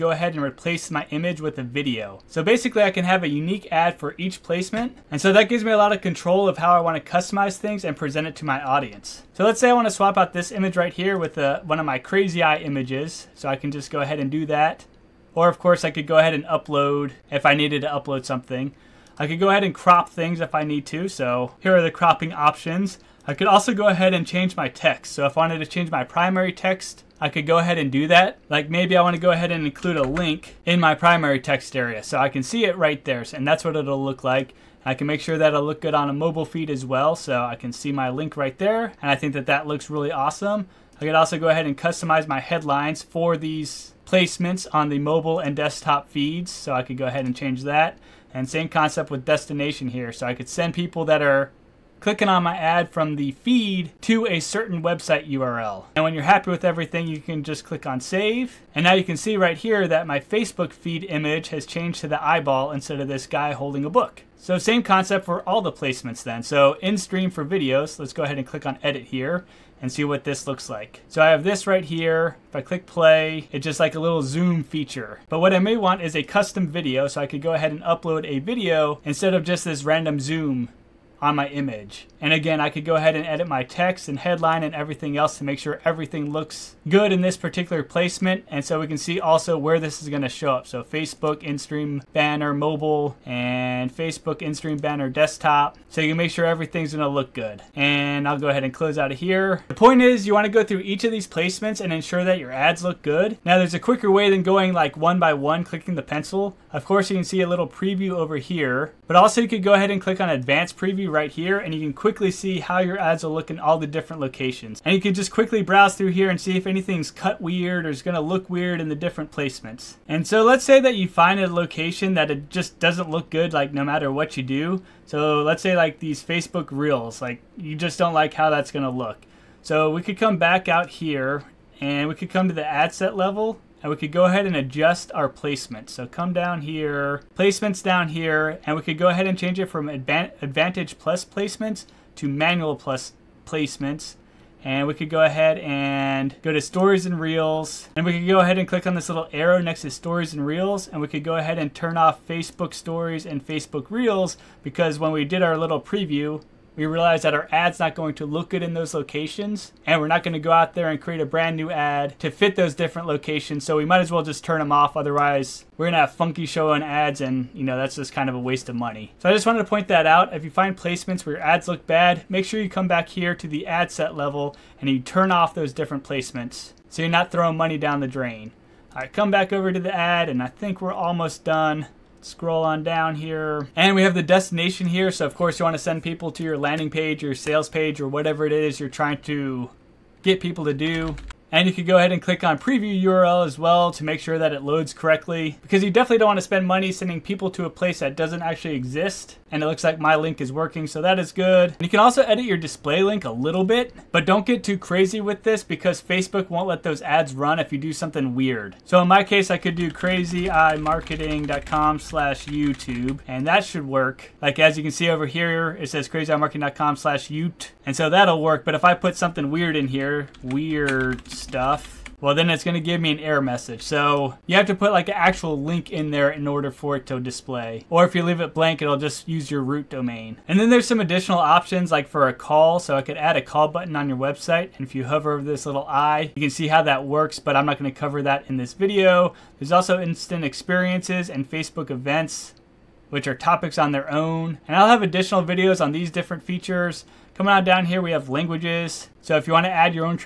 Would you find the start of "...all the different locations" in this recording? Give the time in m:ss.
1:53.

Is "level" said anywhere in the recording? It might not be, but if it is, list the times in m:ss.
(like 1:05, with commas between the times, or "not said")
2:13, 2:54.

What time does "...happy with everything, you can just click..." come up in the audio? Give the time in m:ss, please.
0:56.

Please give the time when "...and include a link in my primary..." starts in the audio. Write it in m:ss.
0:29.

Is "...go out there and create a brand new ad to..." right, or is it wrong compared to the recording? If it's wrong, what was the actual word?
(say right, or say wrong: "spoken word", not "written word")
right.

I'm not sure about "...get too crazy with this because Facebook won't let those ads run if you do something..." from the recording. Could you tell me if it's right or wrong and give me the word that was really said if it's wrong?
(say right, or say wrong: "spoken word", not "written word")
right.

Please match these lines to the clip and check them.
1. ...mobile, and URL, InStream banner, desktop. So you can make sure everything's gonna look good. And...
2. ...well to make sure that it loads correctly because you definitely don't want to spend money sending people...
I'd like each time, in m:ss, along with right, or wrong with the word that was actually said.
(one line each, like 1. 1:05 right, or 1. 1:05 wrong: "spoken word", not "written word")
1. 1:32 wrong: "Facebook", not "URL"
2. 3:13 right.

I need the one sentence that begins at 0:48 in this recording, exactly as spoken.
And same concept with destination here.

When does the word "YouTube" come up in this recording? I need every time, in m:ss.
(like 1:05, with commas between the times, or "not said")
3:32, 3:37.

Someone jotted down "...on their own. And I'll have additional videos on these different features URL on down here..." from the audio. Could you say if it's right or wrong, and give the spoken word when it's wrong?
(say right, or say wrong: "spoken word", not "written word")
wrong: "Coming", not "URL".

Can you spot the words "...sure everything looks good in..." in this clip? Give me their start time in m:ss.
1:25.